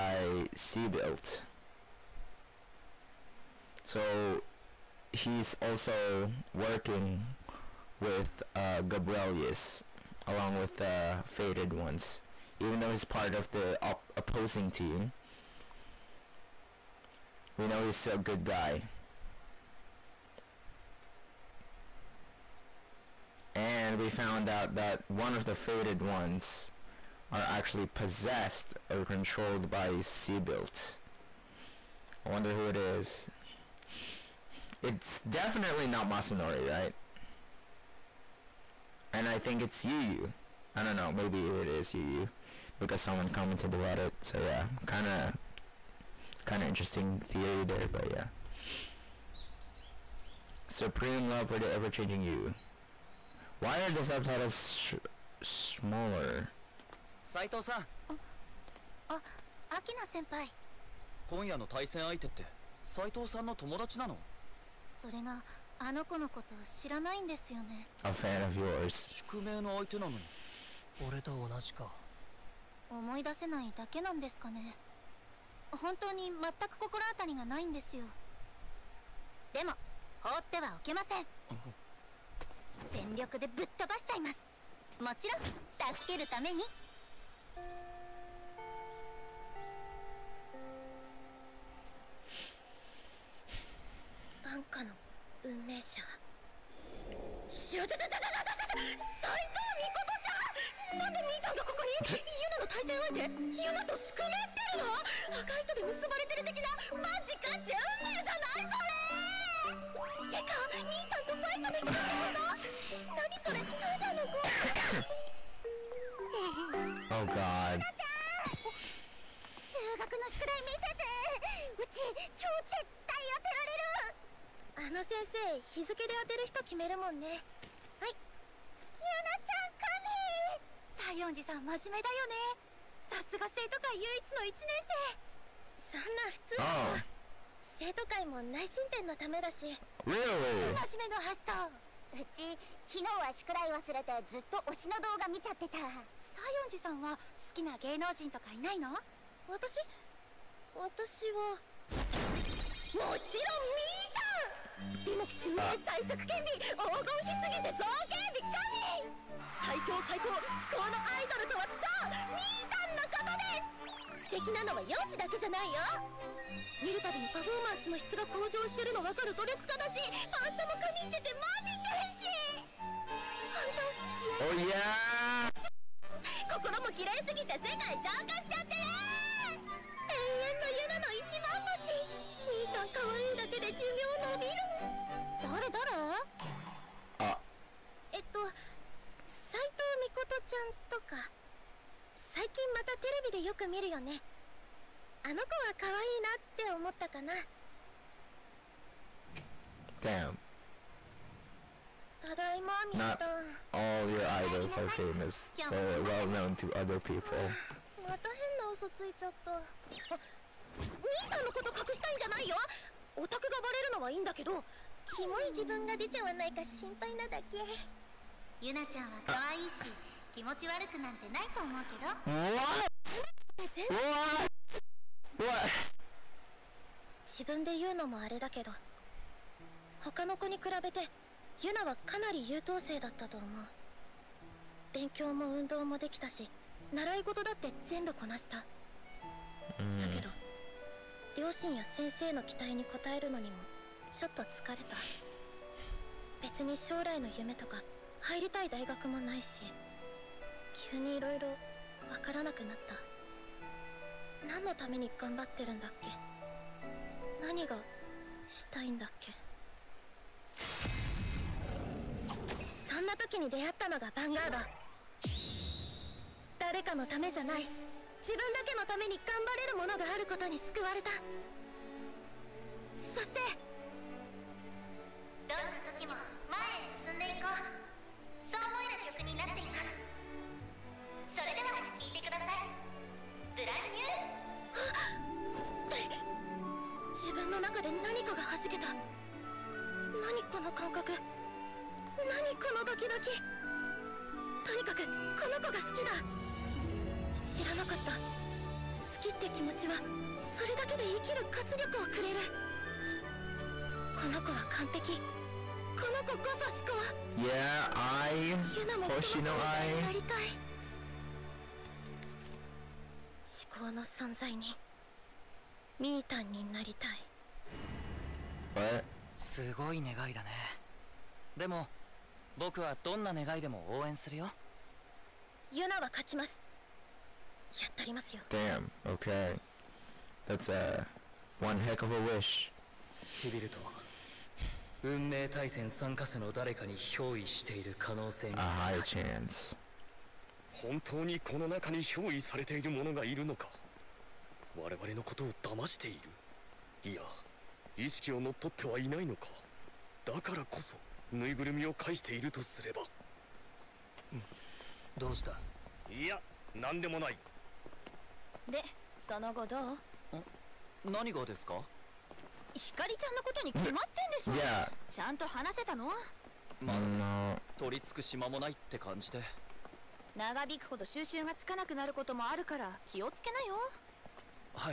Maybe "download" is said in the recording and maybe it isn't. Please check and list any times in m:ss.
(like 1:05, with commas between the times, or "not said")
not said.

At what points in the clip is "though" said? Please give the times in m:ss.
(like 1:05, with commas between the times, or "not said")
0:12.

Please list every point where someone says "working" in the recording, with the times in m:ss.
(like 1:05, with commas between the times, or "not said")
0:06.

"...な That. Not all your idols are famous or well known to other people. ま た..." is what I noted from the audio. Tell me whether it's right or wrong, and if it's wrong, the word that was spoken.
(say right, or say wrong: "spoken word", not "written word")
wrong: "Damn", not "That".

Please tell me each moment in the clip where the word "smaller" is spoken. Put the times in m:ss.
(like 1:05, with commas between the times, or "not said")
0:55.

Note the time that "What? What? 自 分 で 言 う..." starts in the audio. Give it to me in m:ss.
3:43.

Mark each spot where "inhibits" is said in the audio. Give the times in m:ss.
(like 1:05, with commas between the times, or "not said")
not said.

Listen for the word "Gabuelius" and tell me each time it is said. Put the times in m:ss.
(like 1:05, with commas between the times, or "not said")
0:08.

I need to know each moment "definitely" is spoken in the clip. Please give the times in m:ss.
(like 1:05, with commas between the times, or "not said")
0:35.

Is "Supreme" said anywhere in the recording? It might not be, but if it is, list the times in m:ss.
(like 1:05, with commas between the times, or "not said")
0:50.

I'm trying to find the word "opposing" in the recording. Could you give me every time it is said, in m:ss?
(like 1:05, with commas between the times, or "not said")
0:14.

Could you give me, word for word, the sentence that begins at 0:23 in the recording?
And we found out that one of the Faded ones are actually possessed or controlled by Seabilt.